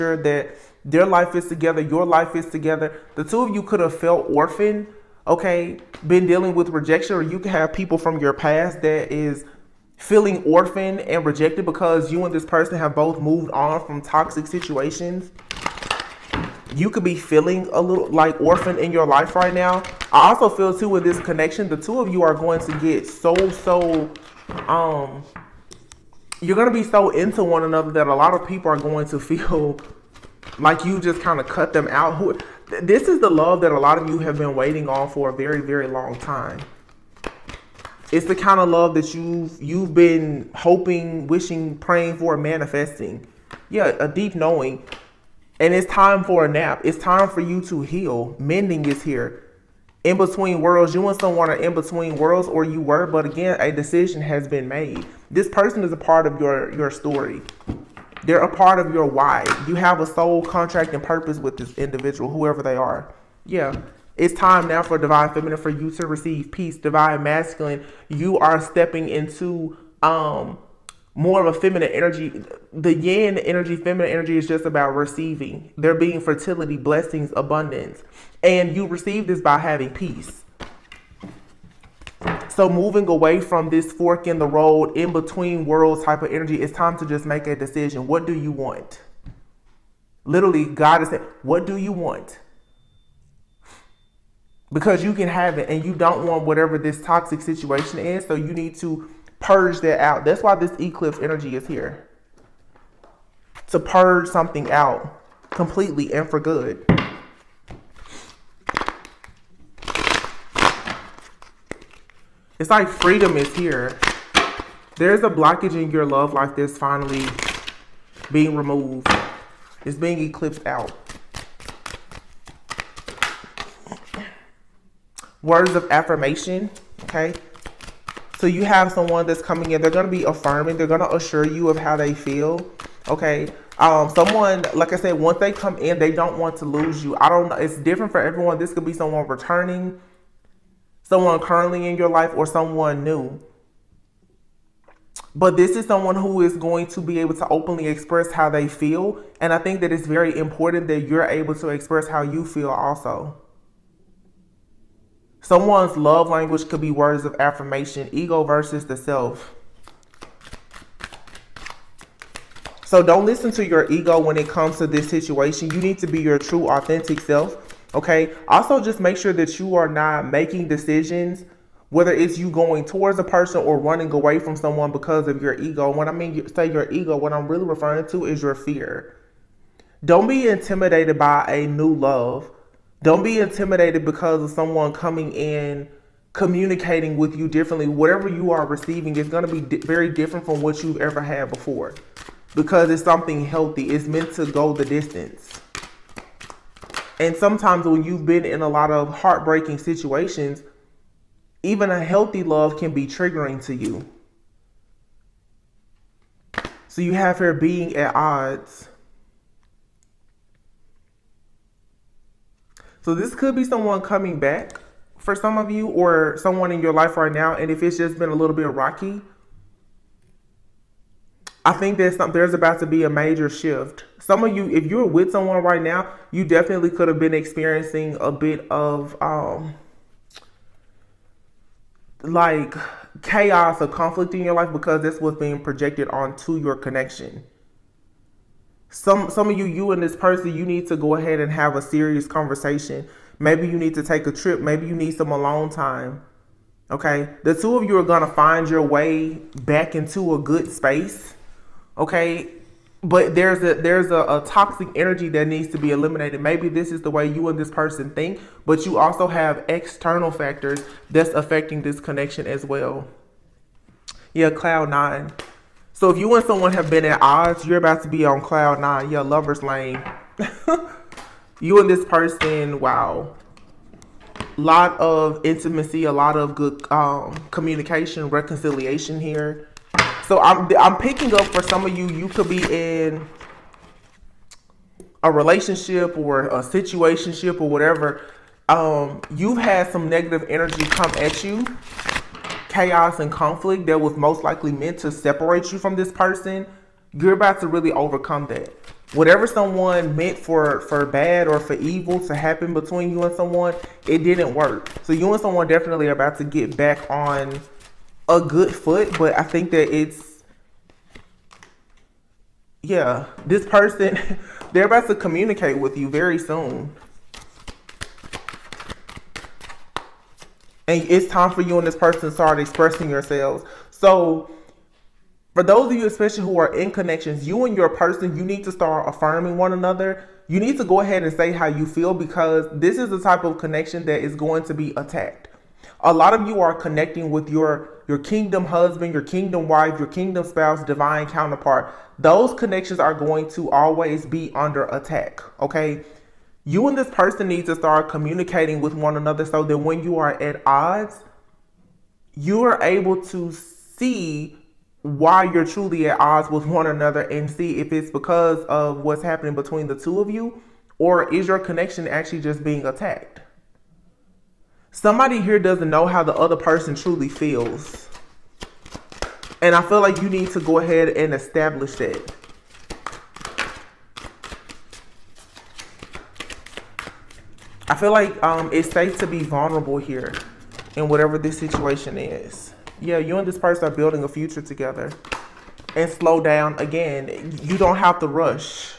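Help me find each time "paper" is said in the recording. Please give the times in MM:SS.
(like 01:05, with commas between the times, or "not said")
not said.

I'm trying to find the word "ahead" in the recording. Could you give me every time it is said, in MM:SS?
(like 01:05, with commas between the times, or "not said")
04:01, 05:30, 06:10.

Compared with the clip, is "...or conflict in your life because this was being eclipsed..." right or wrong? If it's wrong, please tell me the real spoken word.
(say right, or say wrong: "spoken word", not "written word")
wrong: "projected", not "eclipsed".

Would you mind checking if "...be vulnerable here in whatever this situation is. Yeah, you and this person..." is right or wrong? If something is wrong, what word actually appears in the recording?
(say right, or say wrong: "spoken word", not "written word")
right.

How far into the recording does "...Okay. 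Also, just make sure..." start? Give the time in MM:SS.
02:47.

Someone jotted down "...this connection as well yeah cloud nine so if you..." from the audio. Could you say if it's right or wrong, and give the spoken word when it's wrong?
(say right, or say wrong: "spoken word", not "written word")
right.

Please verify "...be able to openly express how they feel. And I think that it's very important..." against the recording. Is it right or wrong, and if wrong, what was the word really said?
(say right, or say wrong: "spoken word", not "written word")
right.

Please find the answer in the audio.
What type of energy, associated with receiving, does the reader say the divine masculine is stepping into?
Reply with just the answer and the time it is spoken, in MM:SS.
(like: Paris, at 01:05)
yin energy, at 01:12.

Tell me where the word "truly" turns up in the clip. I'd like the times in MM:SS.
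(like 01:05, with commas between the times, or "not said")
05:55, 06:06.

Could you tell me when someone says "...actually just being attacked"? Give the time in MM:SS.
06:02.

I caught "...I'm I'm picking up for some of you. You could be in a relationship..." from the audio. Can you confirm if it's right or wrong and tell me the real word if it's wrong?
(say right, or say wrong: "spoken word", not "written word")
right.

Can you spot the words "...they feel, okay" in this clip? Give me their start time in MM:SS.
02:11.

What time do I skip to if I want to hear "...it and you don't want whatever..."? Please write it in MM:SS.
01:35.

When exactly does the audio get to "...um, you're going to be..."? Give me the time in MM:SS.
00:24.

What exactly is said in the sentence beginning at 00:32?
Who this is the love that a lot of you have been waiting on for a very, very long time.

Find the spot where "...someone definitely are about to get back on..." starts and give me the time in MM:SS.
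05:05.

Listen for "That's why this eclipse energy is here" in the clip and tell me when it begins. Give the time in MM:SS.
01:40.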